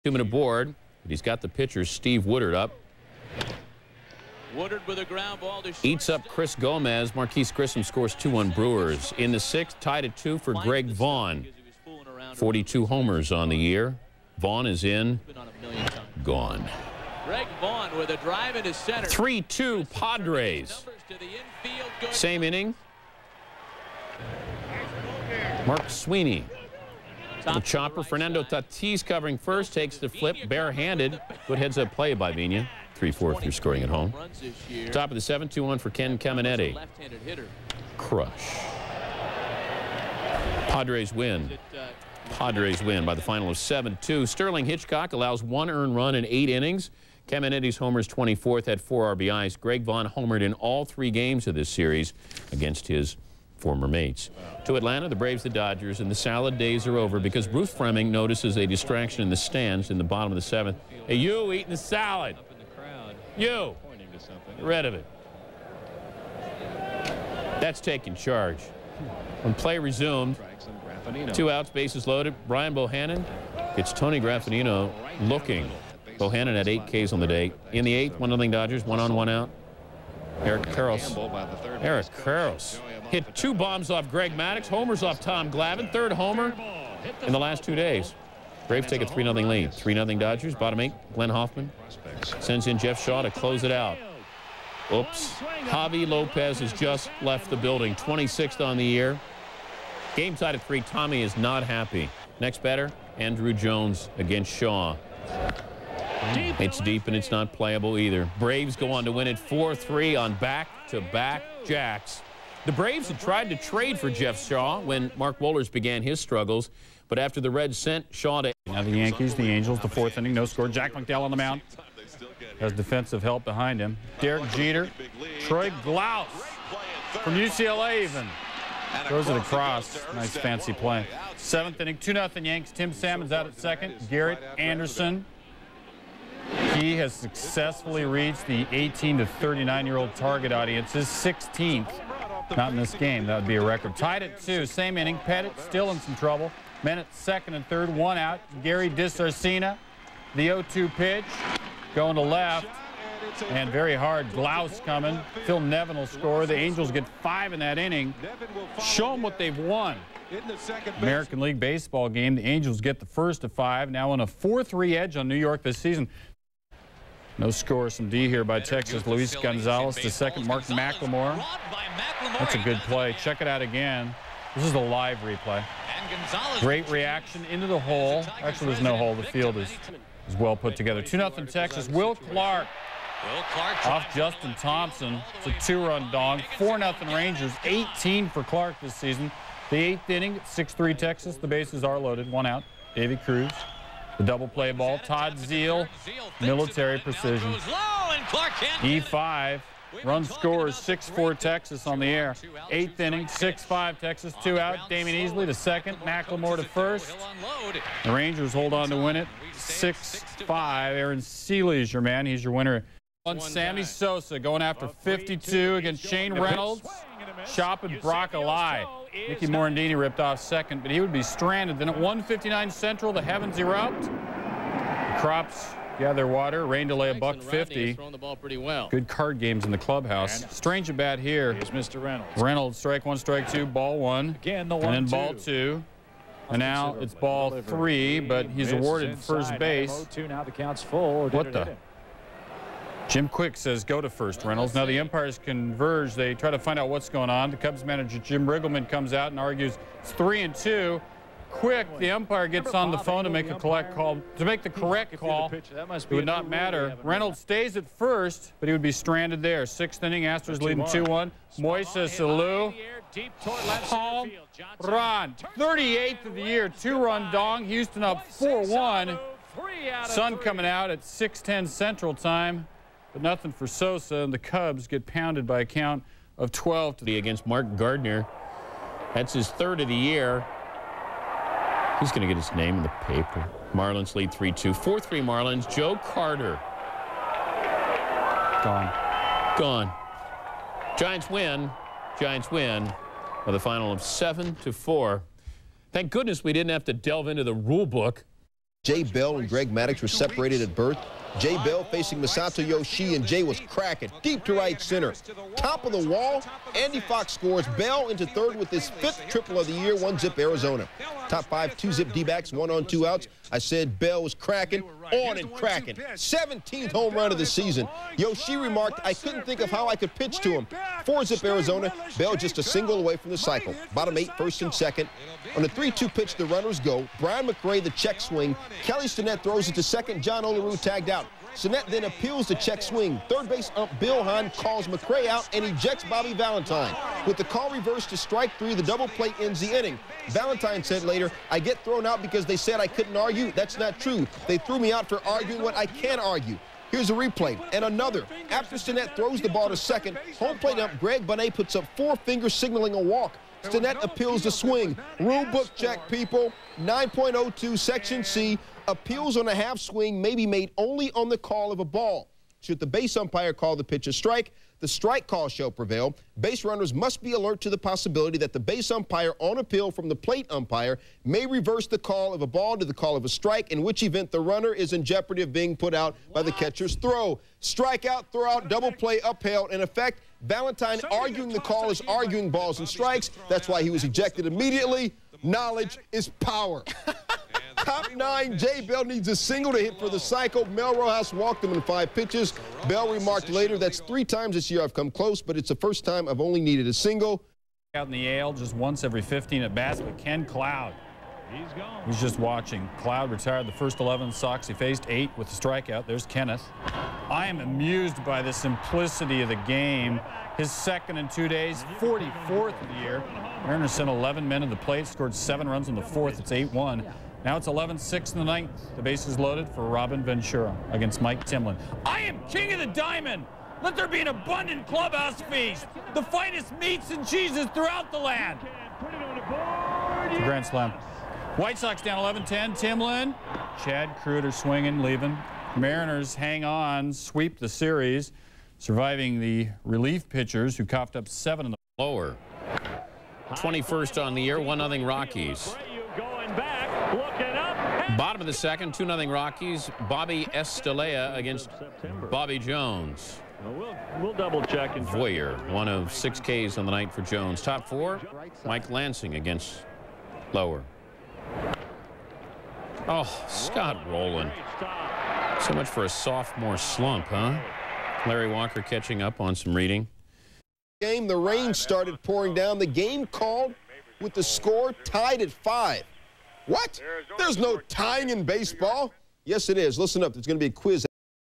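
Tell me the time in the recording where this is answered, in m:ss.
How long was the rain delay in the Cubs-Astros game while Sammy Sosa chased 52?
3:47.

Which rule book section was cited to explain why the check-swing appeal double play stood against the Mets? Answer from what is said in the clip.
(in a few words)
9.02.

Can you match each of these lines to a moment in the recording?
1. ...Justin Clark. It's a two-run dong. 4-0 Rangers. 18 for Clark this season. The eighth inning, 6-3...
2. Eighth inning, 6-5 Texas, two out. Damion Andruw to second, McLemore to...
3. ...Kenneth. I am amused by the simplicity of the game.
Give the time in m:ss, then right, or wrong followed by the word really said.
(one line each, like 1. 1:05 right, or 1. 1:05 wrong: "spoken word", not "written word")
1. 3:04 wrong: "Thompson", not "Clark"
2. 3:22 wrong: "Easley", not "Andruw"
3. 6:46 right.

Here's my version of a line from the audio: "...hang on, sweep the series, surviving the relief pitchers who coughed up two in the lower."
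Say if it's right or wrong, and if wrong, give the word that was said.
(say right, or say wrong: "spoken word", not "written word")
wrong: "seven", not "two".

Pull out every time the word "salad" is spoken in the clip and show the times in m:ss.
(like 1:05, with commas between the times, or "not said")
0:56, 1:01.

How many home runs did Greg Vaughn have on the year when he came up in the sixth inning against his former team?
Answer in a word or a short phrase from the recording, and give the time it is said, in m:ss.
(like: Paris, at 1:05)
42, at 0:12.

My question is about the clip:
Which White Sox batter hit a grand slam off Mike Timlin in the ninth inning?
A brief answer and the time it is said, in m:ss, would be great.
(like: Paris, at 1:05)
Robin Ventura, at 6:59.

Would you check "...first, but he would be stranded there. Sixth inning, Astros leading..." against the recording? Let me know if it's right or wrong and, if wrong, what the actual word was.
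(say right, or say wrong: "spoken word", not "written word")
right.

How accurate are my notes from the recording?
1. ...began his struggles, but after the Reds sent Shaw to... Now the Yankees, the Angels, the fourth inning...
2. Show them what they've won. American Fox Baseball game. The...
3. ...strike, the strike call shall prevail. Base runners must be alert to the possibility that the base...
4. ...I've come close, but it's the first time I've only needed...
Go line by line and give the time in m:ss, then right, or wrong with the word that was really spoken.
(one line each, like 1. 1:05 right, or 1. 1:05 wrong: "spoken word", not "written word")
1. 1:55 right
2. 2:38 wrong: "League", not "Fox"
3. 6:04 right
4. 6:34 right.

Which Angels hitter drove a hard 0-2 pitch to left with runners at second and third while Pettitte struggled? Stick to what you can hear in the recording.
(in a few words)
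Gary DiSarcina.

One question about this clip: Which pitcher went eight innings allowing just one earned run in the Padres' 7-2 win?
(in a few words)
Sterling Hitchcock.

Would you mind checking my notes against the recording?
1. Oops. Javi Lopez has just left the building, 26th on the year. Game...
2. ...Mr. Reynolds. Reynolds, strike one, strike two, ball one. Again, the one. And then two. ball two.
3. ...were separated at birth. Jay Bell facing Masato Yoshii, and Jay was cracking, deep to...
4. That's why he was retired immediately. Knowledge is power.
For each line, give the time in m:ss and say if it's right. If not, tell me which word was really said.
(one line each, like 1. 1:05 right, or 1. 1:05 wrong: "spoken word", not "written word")
1. 1:34 right
2. 3:51 right
3. 5:00 right
4. 6:23 wrong: "ejected", not "retired".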